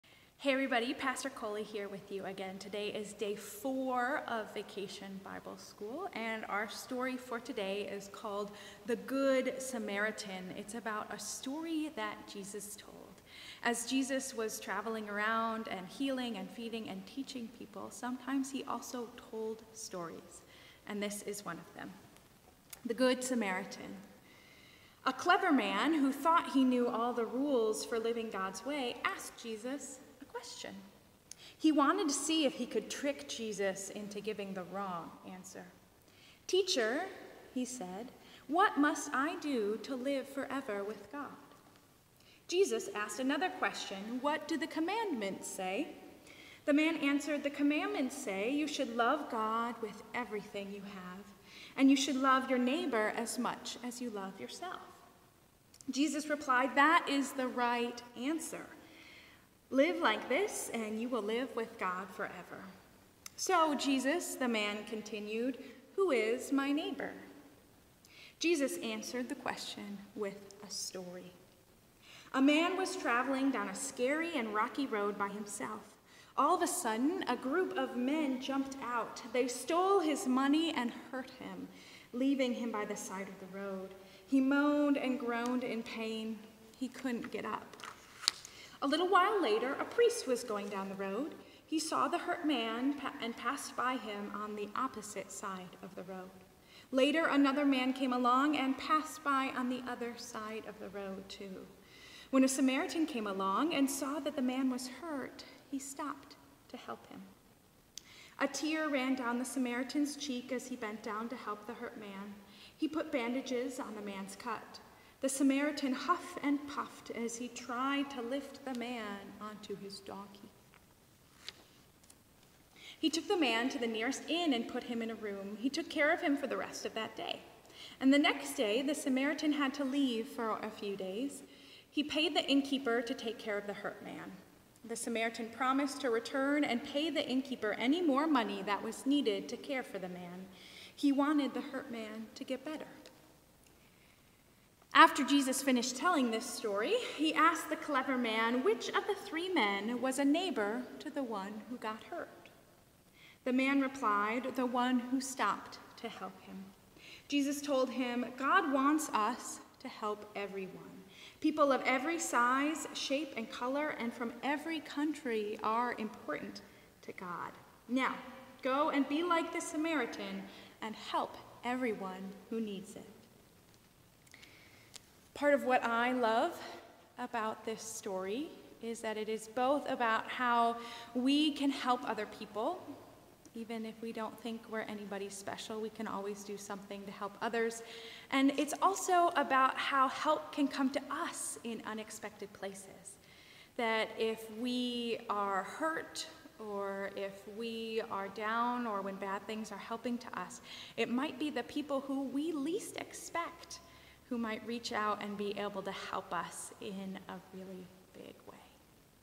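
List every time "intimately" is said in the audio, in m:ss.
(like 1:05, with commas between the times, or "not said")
not said.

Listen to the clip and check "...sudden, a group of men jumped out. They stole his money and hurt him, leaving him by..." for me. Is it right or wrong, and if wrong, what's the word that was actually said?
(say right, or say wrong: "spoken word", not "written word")
right.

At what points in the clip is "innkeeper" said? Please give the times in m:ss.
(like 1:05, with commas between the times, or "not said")
2:12, 2:17.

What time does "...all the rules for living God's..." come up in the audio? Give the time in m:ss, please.
0:26.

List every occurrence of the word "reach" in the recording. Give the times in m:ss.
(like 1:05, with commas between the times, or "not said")
3:24.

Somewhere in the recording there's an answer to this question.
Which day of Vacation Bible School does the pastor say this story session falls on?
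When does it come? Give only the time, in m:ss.
0:03.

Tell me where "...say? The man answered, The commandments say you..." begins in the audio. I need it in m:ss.
0:45.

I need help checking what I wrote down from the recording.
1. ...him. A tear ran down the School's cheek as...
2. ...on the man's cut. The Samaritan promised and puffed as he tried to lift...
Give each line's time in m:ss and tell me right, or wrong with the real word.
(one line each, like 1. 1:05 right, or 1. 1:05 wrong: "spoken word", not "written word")
1. 1:47 wrong: "Samaritan", not "School"
2. 1:53 wrong: "huffed", not "promised".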